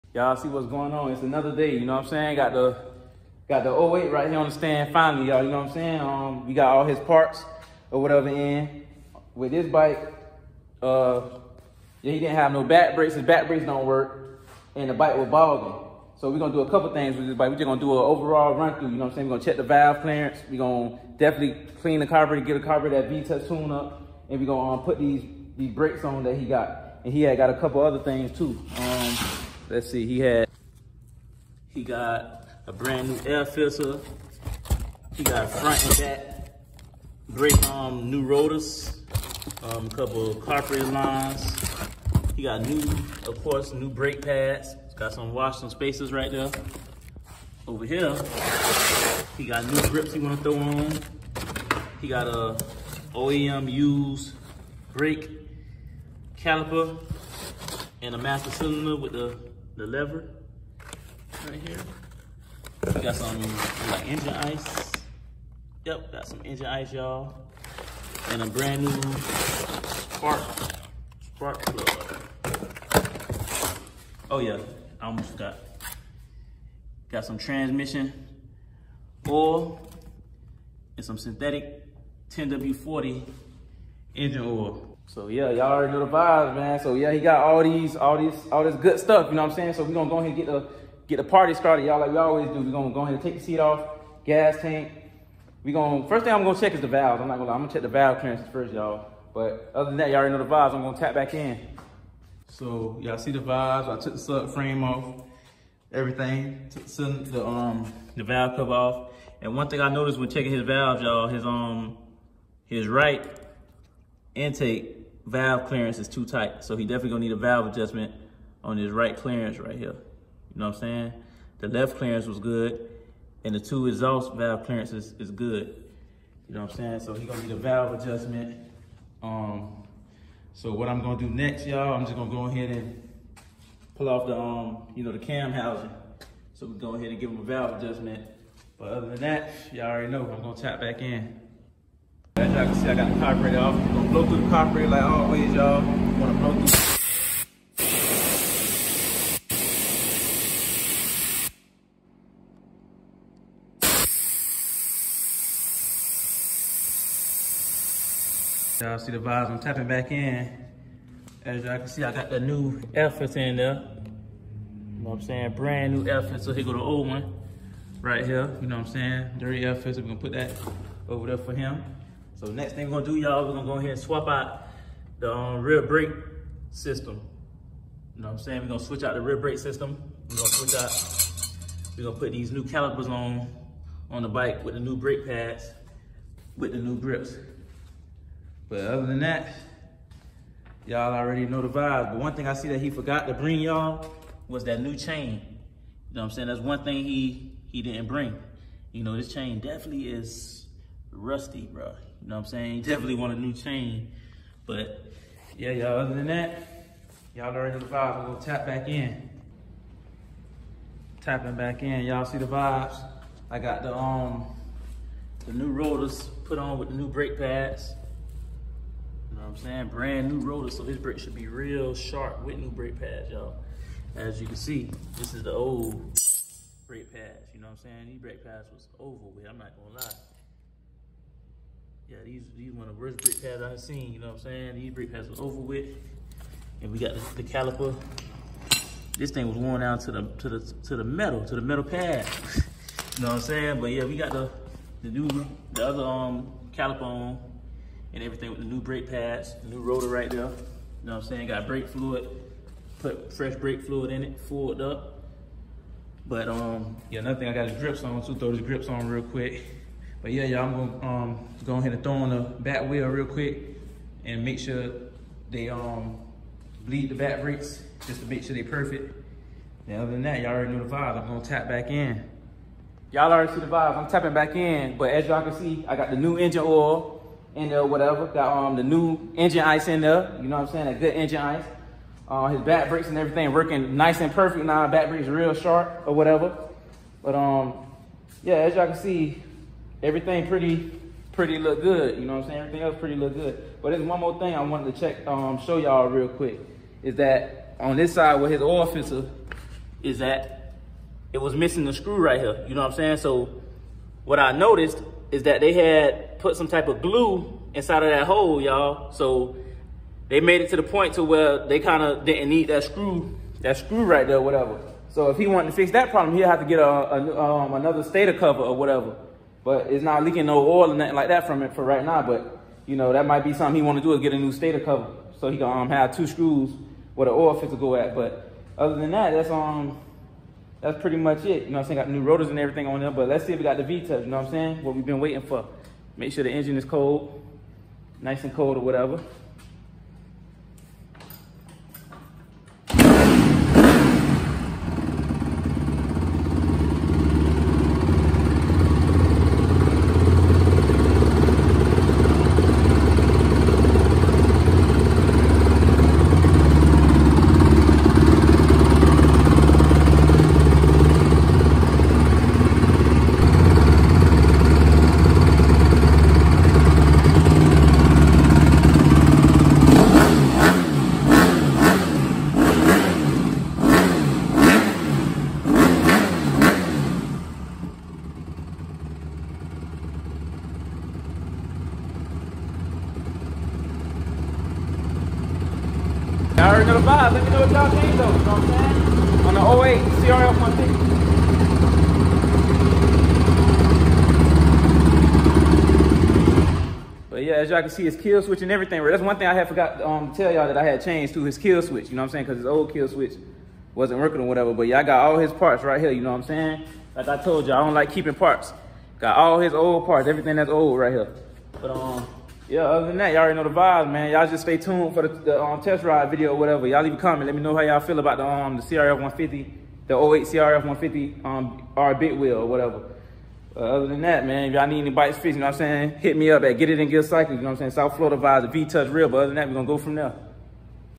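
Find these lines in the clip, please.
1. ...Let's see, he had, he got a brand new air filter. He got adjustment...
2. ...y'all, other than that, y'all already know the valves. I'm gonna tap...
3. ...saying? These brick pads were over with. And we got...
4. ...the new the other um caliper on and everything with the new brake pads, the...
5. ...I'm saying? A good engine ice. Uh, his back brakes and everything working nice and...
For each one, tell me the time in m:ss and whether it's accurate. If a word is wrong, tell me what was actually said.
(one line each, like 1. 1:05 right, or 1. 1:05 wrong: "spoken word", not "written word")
1. 0:29 wrong: "front", not "adjustment"
2. 3:25 wrong: "vibes", not "valves"
3. 3:54 right
4. 4:05 right
5. 4:40 right.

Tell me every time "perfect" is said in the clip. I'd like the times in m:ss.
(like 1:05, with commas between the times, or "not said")
4:28, 4:44.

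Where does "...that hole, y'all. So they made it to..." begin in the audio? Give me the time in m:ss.
5:08.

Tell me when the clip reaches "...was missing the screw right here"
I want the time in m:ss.
5:01.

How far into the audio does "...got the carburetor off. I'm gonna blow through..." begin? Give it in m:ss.
2:22.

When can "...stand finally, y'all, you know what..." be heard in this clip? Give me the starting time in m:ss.
0:04.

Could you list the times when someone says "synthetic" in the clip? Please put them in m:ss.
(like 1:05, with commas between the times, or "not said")
1:21.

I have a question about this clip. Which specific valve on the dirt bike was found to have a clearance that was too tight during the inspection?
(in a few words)
Right intake valve.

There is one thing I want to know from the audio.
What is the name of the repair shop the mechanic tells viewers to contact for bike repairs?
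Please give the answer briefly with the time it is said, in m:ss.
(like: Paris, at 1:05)
Get It In Gear Cycles, at 7:06.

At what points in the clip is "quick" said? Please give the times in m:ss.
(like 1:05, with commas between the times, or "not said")
4:19, 4:23, 4:56.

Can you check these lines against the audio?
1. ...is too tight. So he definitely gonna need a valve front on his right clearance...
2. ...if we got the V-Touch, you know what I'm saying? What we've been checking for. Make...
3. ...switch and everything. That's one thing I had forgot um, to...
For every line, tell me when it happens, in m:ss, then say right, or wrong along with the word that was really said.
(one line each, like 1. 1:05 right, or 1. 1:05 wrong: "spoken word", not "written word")
1. 1:55 wrong: "adjustment", not "front"
2. 5:33 wrong: "waiting", not "checking"
3. 6:38 right.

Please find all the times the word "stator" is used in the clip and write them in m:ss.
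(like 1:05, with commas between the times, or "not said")
5:18, 5:24.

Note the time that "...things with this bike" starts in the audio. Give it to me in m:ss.
0:16.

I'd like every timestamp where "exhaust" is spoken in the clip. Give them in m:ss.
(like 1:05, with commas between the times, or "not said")
2:03.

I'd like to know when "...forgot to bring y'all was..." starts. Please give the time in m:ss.
3:12.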